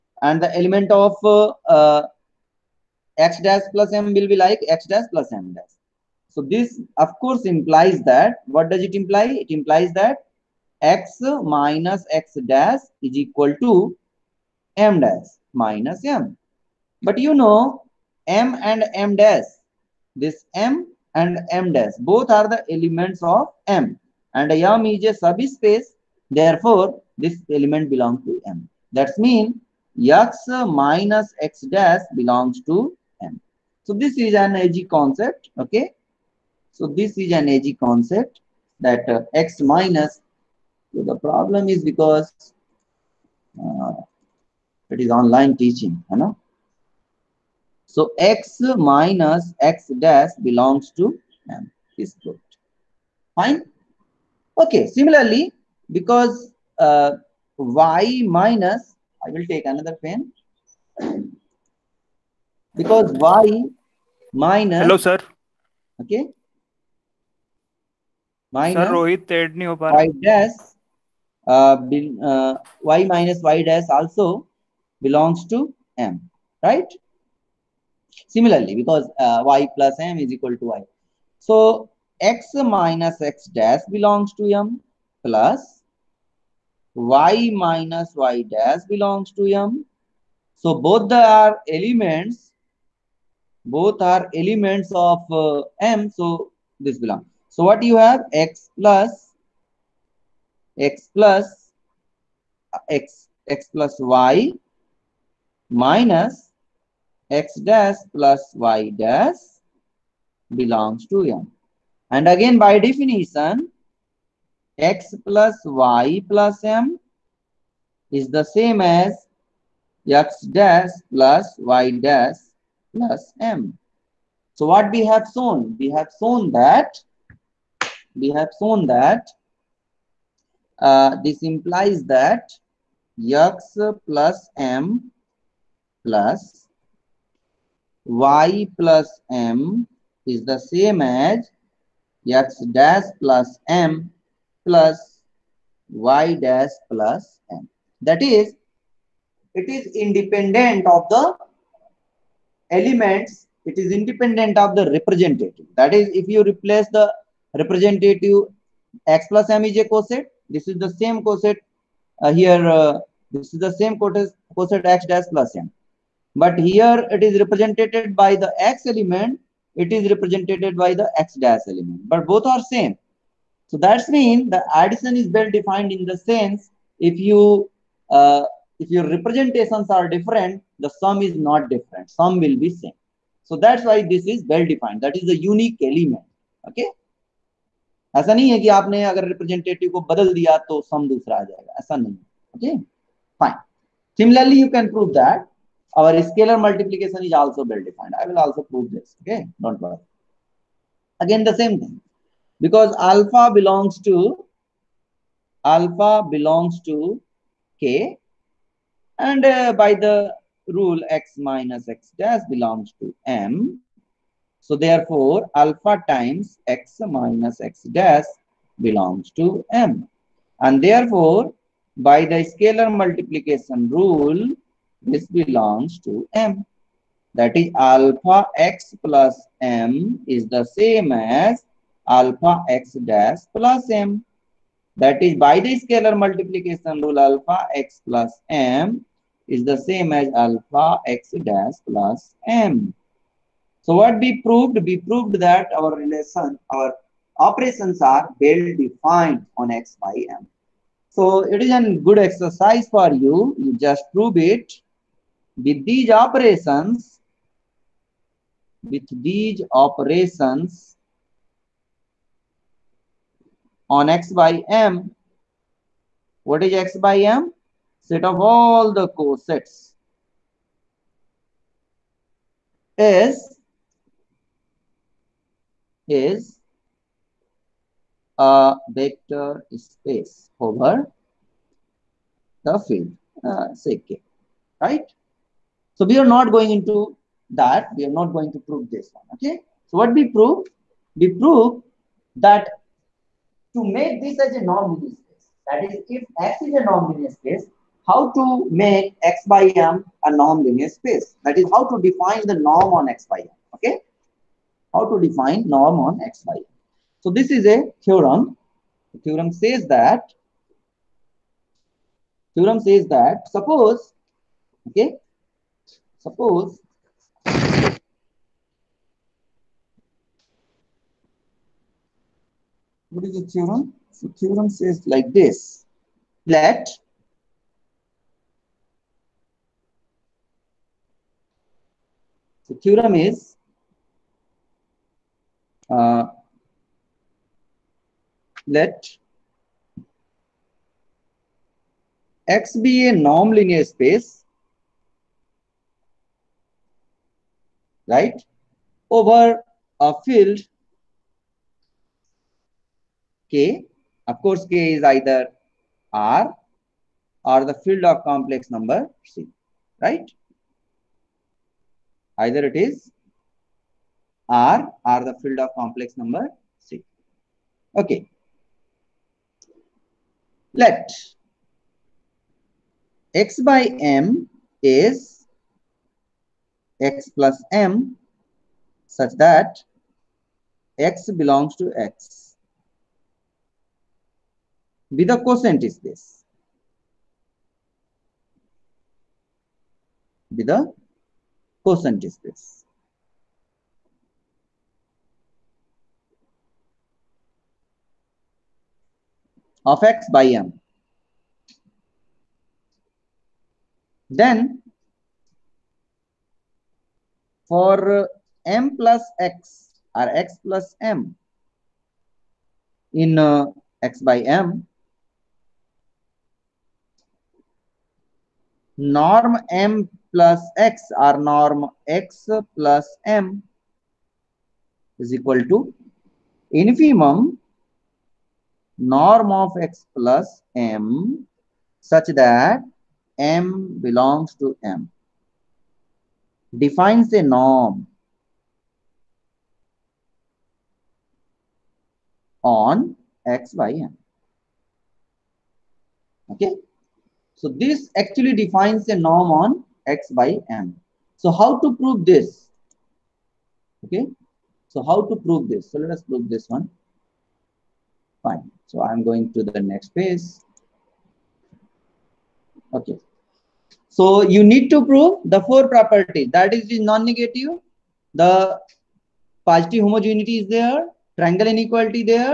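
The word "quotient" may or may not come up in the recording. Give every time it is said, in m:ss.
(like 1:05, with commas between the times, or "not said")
6:25, 6:31.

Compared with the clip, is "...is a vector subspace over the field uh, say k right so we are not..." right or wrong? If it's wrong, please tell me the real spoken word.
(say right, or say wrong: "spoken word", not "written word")
wrong: "space", not "subspace".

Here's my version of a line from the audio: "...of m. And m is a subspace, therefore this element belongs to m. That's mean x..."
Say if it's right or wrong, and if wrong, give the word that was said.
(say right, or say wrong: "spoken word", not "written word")
right.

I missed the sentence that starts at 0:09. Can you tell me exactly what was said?
It implies that x minus x dash is equal to m dash minus m.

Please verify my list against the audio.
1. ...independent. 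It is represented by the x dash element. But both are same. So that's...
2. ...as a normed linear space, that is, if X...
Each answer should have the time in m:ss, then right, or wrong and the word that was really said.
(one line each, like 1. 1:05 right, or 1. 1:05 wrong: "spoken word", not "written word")
1. 2:48 wrong: "element", not "independent"
2. 4:54 right.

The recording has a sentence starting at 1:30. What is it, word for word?
So both are elements, both are elements of uh, m.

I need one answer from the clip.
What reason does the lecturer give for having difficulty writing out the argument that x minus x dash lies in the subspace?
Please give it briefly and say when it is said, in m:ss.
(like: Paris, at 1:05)
online teaching, at 0:44.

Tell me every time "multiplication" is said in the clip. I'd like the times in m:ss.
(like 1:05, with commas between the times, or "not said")
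3:16, 3:43, 3:56.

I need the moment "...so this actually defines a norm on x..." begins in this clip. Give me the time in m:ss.
7:27.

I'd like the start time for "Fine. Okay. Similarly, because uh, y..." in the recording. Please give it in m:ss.
0:53.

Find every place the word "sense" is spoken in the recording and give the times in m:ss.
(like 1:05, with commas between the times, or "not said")
2:56.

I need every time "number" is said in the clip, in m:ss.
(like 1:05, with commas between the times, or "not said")
5:58, 6:06.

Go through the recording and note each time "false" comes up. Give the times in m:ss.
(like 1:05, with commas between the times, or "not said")
not said.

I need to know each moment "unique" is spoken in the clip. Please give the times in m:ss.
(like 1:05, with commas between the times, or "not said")
3:05.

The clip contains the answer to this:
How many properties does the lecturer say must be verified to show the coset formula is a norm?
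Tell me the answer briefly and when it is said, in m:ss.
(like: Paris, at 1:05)
4, at 7:45.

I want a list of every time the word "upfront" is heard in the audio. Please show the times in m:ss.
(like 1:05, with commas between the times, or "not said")
not said.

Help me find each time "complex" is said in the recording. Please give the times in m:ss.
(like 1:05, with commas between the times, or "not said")
5:58, 6:05.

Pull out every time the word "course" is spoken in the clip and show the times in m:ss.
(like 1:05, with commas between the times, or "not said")
0:07, 5:54.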